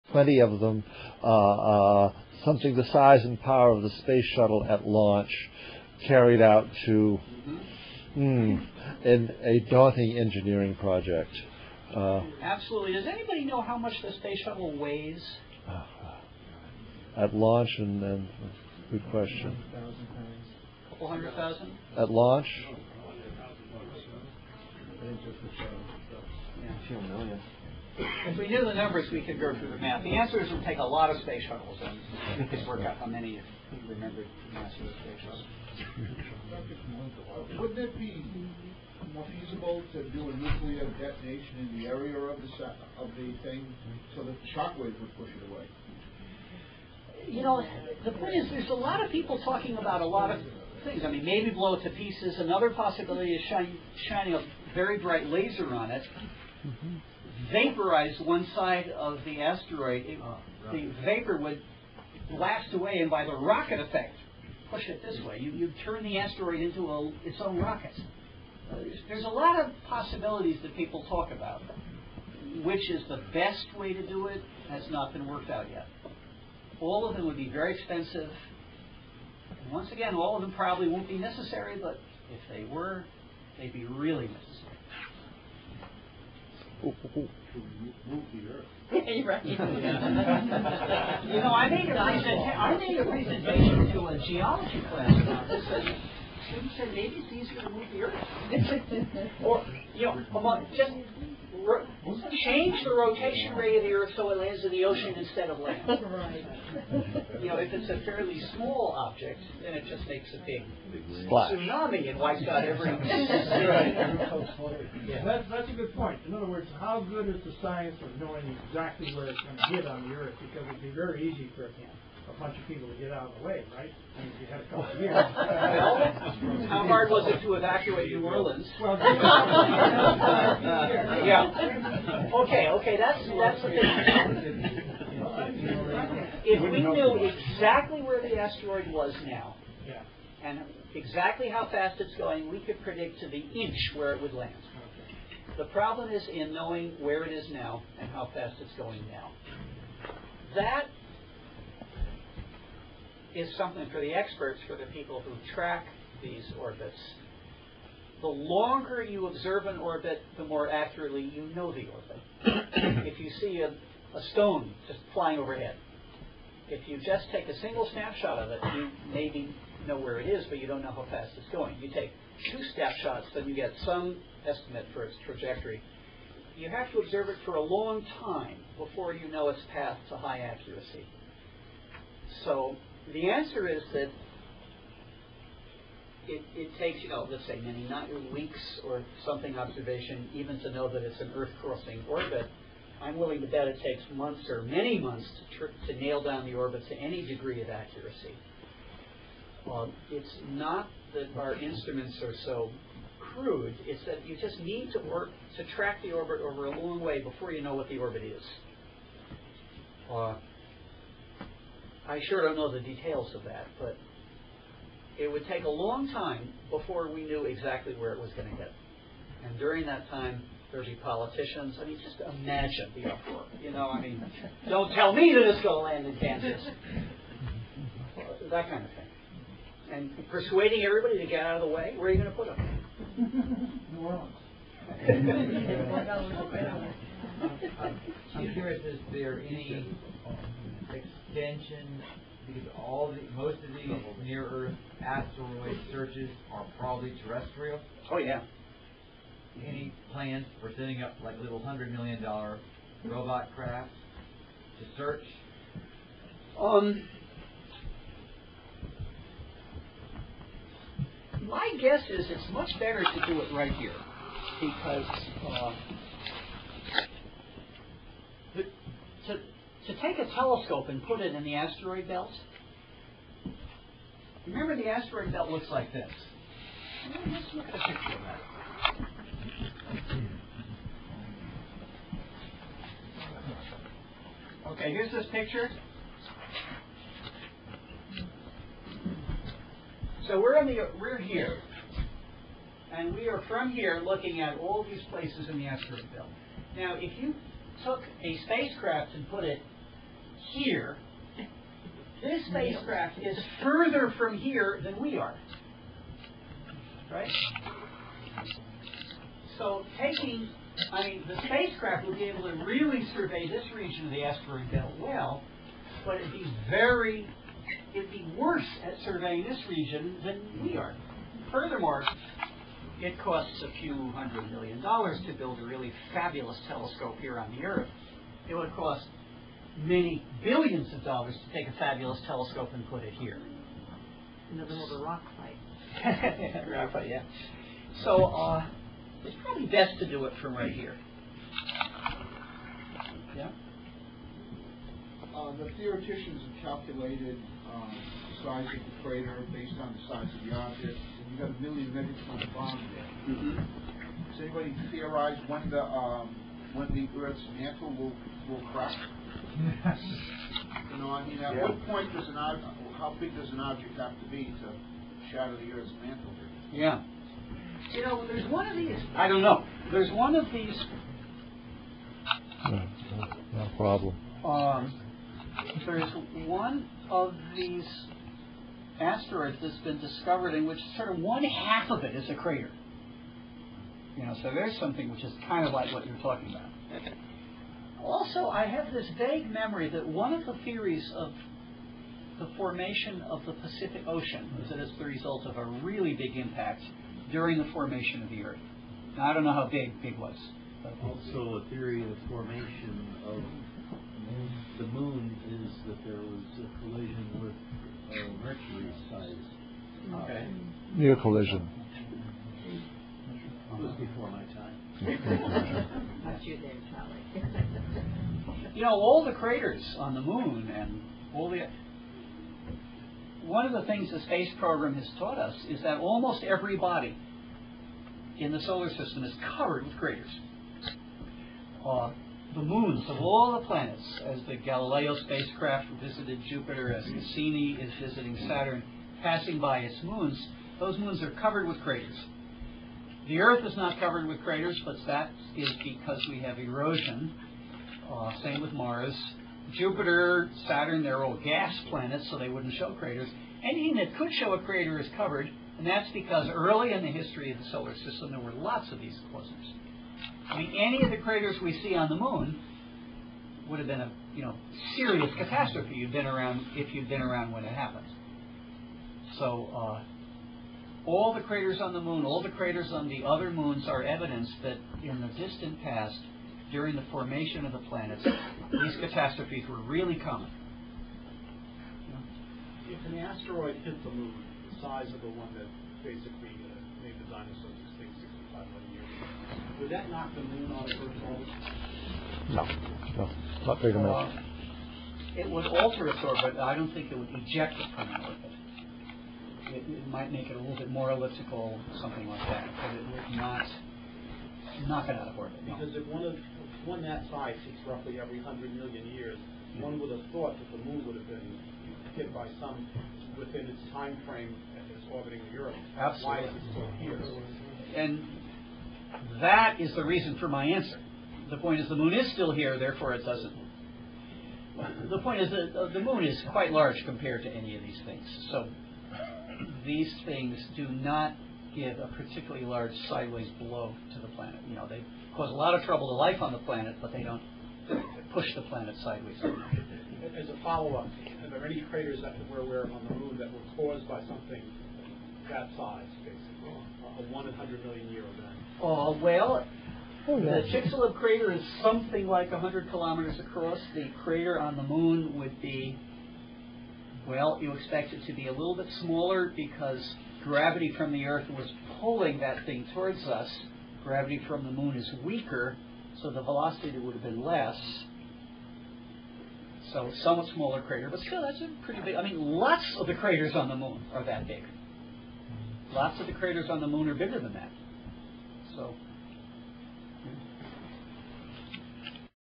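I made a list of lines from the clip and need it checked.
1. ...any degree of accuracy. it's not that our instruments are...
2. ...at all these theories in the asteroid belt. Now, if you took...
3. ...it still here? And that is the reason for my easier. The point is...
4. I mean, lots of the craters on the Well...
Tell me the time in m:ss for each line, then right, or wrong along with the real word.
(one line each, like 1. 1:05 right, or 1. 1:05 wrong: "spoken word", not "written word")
1. 3:16 right
2. 4:54 wrong: "places", not "theories"
3. 8:36 wrong: "answer", not "easier"
4. 9:32 wrong: "Moon", not "Well".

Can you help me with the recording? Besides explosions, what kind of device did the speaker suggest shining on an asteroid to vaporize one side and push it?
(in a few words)
a very bright laser.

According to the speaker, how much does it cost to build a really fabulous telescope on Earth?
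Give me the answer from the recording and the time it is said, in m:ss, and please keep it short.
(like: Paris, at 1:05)
a few hundred million dollars, at 5:23.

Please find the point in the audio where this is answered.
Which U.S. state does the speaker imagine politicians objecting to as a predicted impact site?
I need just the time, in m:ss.
3:46.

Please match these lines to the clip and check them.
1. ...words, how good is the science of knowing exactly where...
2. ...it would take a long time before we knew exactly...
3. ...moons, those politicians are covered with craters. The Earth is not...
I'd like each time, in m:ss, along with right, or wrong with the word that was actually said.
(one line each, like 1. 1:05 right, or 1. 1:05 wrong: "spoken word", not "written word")
1. 1:56 right
2. 3:35 right
3. 7:20 wrong: "moons", not "politicians".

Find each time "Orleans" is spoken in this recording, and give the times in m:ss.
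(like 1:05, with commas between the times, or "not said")
2:08, 3:54.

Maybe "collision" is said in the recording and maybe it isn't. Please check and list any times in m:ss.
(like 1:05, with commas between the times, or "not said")
6:46, 6:51.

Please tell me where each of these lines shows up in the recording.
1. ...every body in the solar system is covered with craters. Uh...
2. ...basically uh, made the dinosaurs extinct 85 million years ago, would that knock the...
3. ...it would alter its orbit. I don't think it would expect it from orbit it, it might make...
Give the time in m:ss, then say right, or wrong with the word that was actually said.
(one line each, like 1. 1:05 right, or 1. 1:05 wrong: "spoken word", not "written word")
1. 7:06 right
2. 8:06 wrong: "65", not "85"
3. 8:15 wrong: "eject", not "expect".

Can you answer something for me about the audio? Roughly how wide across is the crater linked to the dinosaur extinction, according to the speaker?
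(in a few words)
100 kilometers.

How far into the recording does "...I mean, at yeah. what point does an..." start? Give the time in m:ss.
6:01.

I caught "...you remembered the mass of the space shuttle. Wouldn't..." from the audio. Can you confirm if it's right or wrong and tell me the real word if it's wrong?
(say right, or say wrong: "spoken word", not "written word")
right.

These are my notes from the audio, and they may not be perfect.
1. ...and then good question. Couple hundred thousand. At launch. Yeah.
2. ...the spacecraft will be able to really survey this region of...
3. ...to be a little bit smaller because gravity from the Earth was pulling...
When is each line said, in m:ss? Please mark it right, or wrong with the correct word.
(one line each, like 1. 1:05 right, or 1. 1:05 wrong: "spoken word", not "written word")
1. 0:17 right
2. 5:11 right
3. 9:18 right.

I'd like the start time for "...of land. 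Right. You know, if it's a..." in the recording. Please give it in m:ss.
1:45.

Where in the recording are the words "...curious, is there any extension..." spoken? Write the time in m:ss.
3:58.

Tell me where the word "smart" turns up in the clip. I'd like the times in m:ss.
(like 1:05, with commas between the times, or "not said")
not said.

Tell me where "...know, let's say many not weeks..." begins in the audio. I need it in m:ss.
3:07.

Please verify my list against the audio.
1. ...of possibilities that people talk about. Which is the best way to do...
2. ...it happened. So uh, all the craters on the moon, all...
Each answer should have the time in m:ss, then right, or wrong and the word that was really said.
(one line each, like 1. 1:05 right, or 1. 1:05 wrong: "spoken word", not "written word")
1. 1:09 right
2. 7:47 right.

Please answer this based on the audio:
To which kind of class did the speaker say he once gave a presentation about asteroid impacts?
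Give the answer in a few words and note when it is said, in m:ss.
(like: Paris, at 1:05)
geology class, at 1:34.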